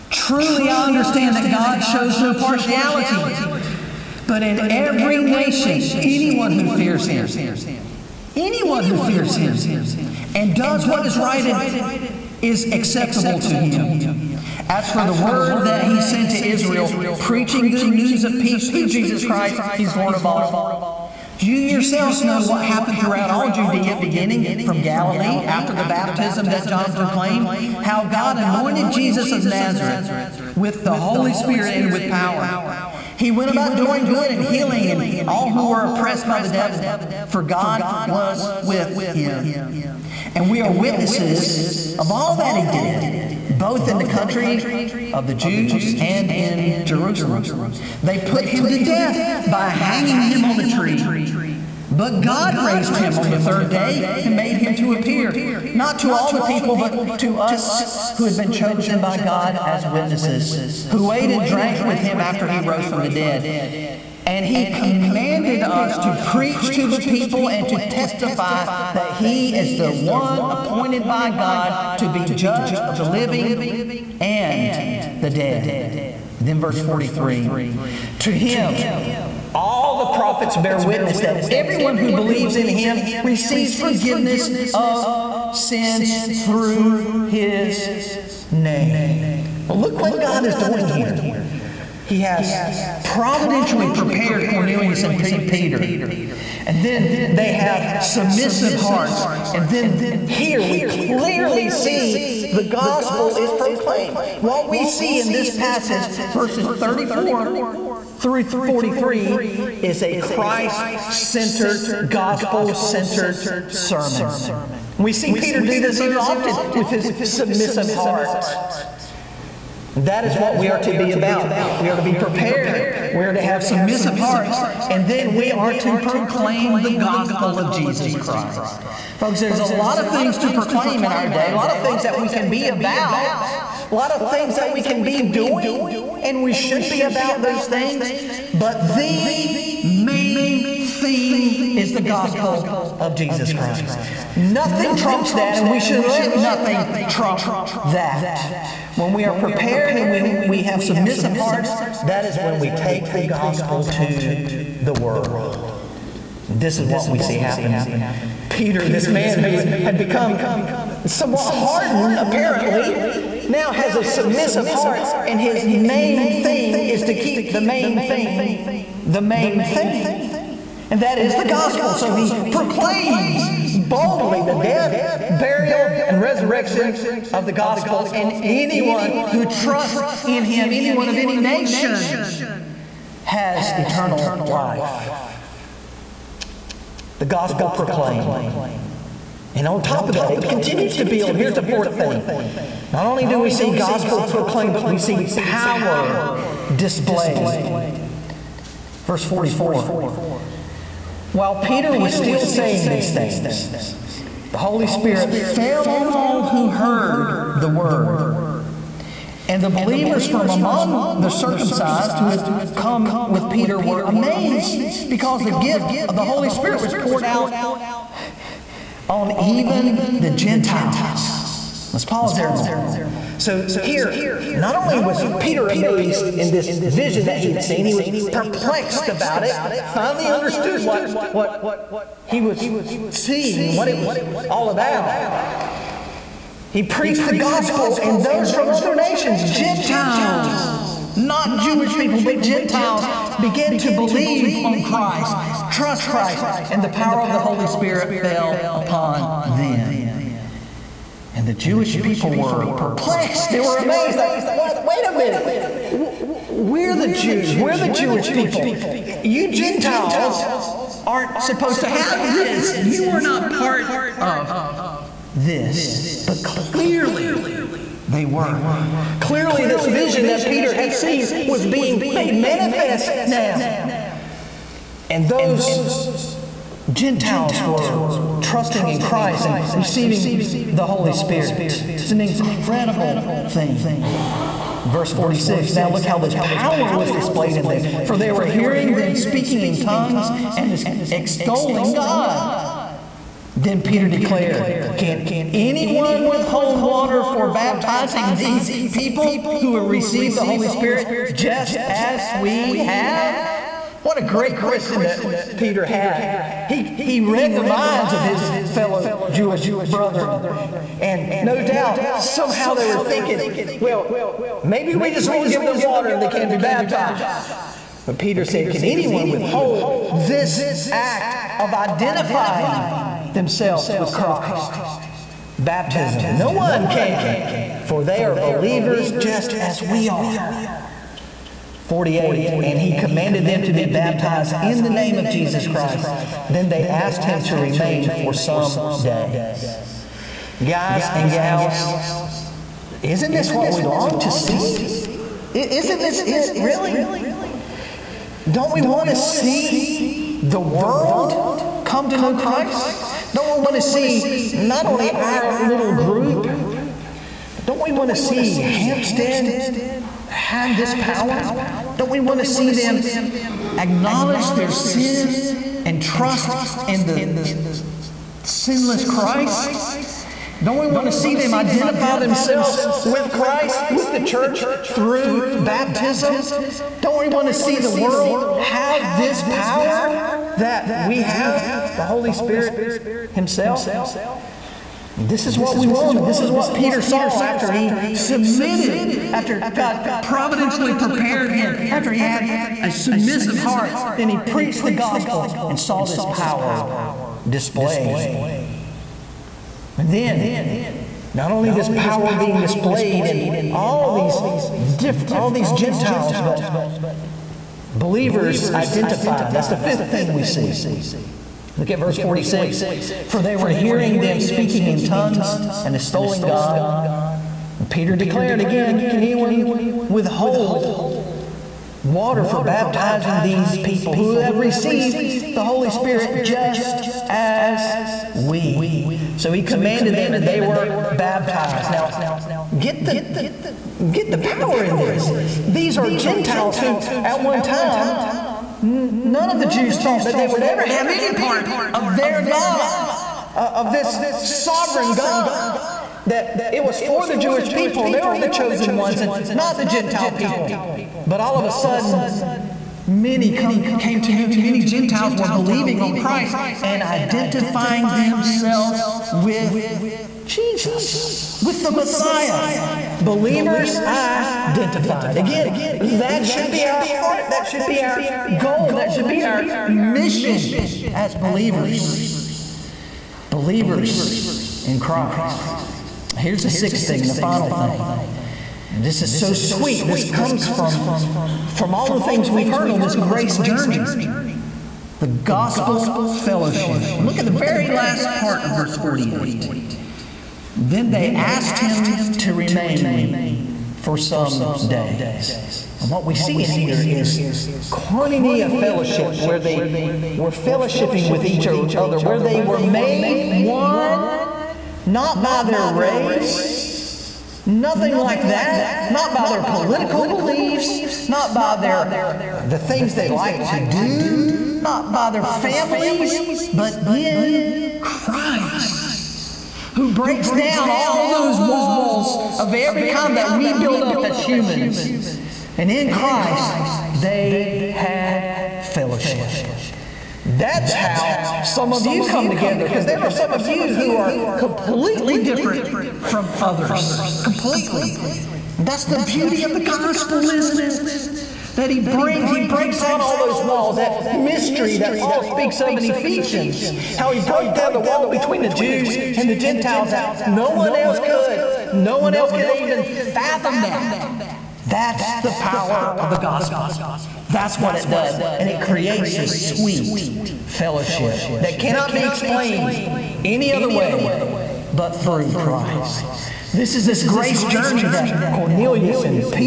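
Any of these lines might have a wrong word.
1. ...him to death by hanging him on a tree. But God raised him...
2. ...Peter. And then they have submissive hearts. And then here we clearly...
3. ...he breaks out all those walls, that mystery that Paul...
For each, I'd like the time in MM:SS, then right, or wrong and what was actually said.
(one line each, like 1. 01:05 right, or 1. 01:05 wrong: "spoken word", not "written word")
1. 00:48 right
2. 01:35 right
3. 09:02 right.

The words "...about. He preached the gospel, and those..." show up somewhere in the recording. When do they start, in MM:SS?
03:54.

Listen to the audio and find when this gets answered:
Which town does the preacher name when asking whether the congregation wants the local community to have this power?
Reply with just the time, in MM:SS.
05:58.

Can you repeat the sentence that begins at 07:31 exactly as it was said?
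But all of a sudden, Many come, came to know him.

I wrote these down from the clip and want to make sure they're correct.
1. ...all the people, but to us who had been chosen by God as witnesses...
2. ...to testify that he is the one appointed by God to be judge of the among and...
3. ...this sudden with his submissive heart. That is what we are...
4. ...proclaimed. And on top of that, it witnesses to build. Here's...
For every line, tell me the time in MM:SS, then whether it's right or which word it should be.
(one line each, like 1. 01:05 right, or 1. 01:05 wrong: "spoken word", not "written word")
1. 00:56 right
2. 01:07 wrong: "living", not "among"
3. 01:55 wrong: "often", not "sudden"
4. 03:07 wrong: "continues", not "witnesses".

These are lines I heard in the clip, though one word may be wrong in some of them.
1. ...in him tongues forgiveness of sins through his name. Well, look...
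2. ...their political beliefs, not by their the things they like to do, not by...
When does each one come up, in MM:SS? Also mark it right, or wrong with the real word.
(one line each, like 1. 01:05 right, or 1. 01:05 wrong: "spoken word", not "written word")
1. 01:22 wrong: "receives", not "tongues"
2. 08:29 right.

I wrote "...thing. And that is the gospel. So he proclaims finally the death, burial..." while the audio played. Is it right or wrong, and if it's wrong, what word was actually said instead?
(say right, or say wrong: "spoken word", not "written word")
wrong: "boldly", not "finally".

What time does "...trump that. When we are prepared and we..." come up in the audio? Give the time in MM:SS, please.
02:27.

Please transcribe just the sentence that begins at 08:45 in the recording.
And in Christ, they had fellowship.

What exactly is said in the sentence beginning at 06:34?
Then he preached the gospel and saw this power displayed.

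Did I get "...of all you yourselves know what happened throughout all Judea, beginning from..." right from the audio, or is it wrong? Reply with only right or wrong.
right.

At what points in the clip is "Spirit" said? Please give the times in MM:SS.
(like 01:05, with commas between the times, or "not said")
00:31, 03:24, 03:36, 04:07, 04:41, 05:00, 06:22, 07:05.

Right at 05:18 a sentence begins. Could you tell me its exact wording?
But Peter said, Can anyone withhold this act of identifying themselves with Christ?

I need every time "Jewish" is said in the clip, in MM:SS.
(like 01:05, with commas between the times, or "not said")
04:01, 04:11, 04:17, 05:09, 07:27.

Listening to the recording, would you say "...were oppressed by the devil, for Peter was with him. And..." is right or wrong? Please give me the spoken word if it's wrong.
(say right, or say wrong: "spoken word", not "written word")
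wrong: "God", not "Peter".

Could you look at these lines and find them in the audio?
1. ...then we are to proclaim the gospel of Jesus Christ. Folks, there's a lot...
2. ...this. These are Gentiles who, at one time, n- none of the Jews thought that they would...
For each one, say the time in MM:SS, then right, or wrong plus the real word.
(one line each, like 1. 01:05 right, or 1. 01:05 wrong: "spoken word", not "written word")
1. 02:05 right
2. 07:14 right.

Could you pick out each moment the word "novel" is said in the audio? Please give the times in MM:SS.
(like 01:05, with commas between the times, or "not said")
not said.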